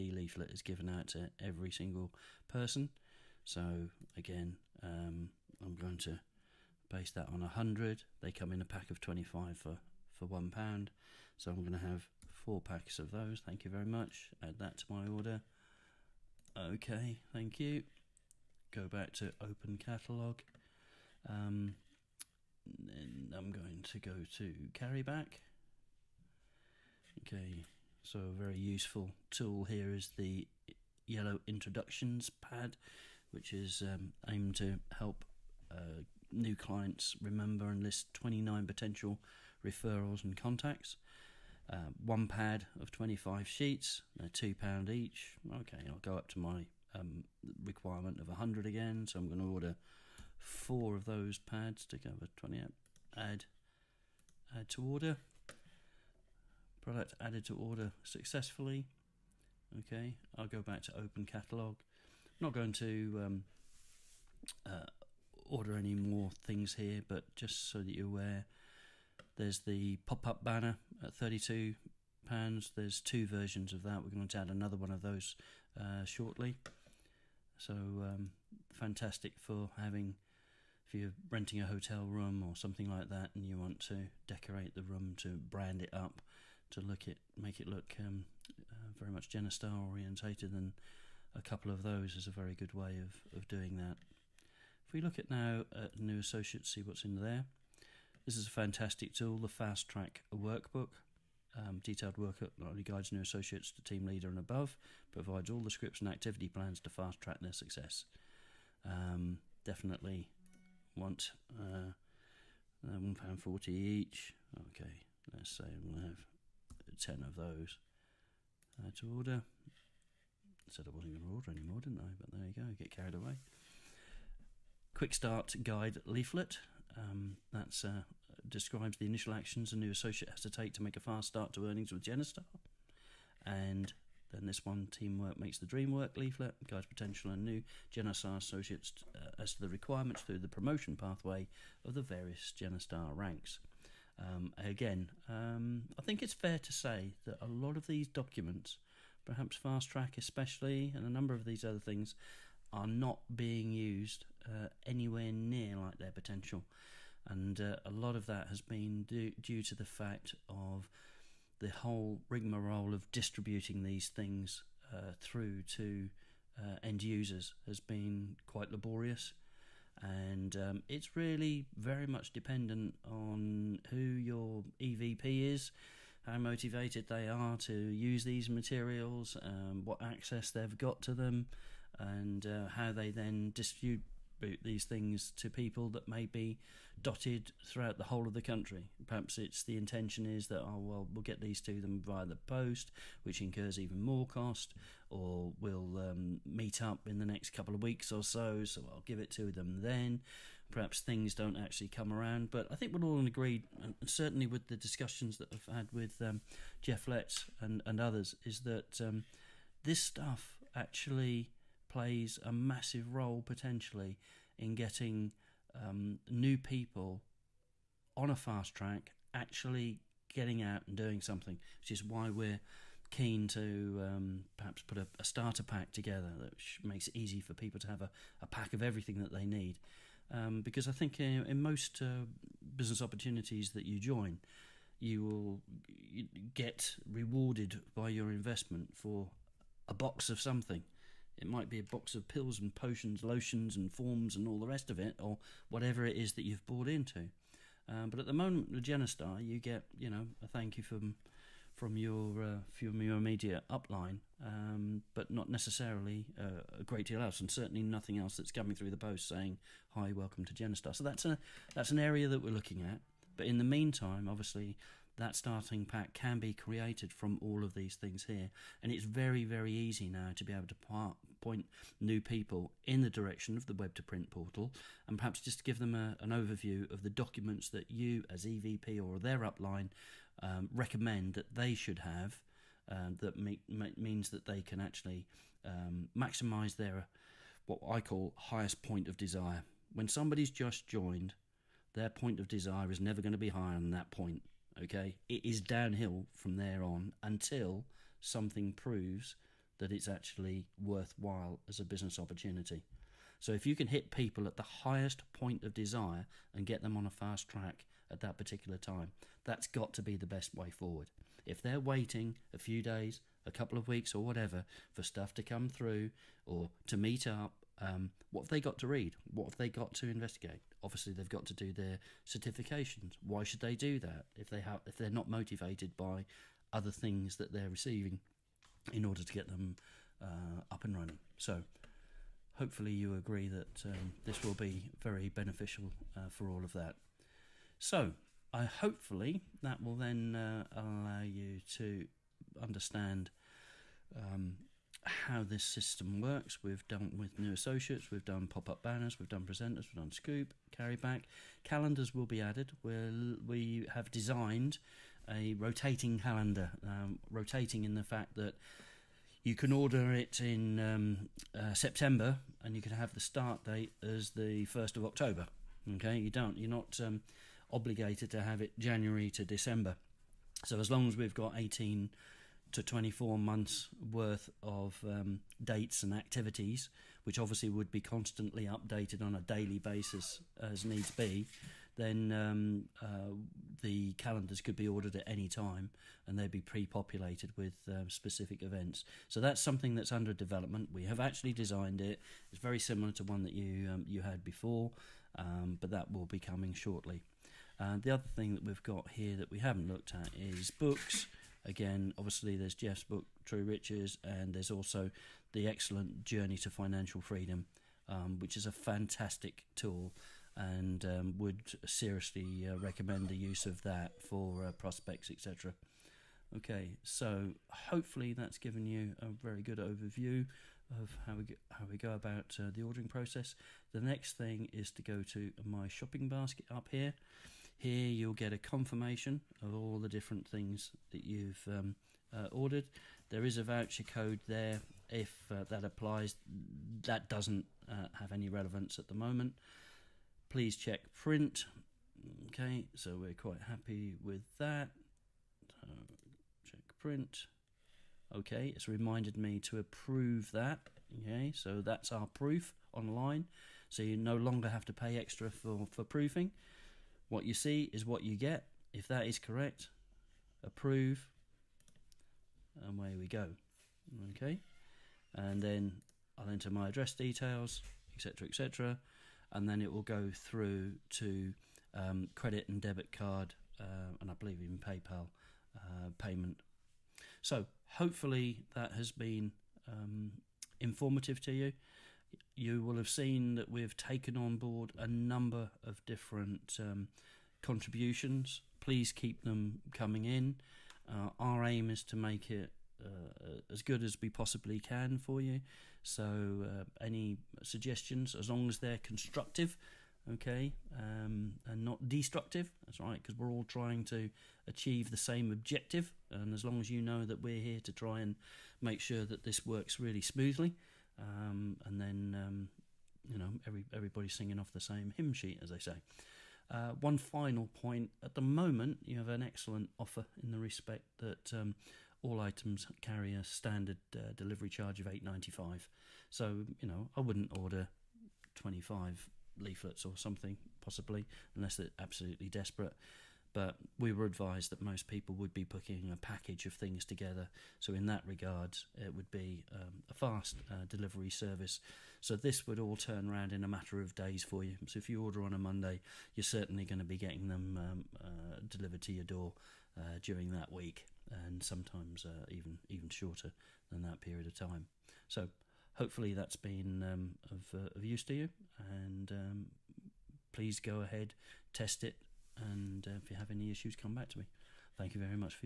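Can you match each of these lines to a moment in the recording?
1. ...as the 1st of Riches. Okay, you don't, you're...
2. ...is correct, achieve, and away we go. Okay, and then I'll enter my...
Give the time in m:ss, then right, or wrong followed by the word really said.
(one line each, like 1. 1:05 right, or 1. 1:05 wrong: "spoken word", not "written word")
1. 6:04 wrong: "October", not "Riches"
2. 7:39 wrong: "approve", not "achieve".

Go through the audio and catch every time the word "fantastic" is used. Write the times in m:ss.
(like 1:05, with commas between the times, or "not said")
1:18, 1:38, 6:48.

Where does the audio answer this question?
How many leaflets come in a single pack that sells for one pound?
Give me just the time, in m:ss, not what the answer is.
0:08.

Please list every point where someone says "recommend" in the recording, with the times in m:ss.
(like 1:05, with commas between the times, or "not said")
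4:40, 6:52.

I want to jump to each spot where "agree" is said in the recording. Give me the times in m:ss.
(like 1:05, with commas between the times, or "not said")
3:23, 5:33.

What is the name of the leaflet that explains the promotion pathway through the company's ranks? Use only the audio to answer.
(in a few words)
Teamwork Makes the Dream Work.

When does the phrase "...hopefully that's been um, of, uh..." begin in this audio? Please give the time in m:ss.
9:15.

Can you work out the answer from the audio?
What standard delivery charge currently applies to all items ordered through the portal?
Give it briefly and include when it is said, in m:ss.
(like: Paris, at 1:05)
£8.95, at 8:45.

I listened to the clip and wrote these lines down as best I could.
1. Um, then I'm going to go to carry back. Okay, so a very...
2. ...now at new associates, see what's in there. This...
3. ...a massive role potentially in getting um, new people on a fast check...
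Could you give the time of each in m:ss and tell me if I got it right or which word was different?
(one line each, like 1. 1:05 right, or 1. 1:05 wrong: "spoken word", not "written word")
1. 0:21 right
2. 1:35 right
3. 3:32 wrong: "track", not "check".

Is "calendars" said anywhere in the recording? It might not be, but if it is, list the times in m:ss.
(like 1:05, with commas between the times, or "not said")
5:51, 5:56, 6:24.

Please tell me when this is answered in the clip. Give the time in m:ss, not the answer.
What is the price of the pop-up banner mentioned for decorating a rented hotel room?
1:11.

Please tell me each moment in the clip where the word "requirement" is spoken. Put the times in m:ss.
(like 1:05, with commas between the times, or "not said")
0:47, 2:19.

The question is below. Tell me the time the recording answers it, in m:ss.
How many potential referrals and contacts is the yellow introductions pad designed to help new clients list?
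0:38.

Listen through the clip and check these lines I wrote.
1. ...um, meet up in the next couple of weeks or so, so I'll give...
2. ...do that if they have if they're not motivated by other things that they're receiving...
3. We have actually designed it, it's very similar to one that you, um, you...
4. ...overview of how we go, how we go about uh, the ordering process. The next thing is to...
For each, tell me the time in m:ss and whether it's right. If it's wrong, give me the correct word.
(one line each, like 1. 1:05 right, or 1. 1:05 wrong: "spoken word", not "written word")
1. 3:15 right
2. 5:23 right
3. 6:30 right
4. 6:59 right.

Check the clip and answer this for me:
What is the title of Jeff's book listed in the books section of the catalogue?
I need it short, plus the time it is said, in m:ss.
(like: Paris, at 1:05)
True Riches, at 6:43.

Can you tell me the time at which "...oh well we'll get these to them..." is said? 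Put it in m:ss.
3:10.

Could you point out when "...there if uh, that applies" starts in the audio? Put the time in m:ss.
7:14.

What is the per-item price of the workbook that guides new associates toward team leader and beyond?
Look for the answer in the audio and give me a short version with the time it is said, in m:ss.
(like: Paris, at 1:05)
£1.40, at 1:52.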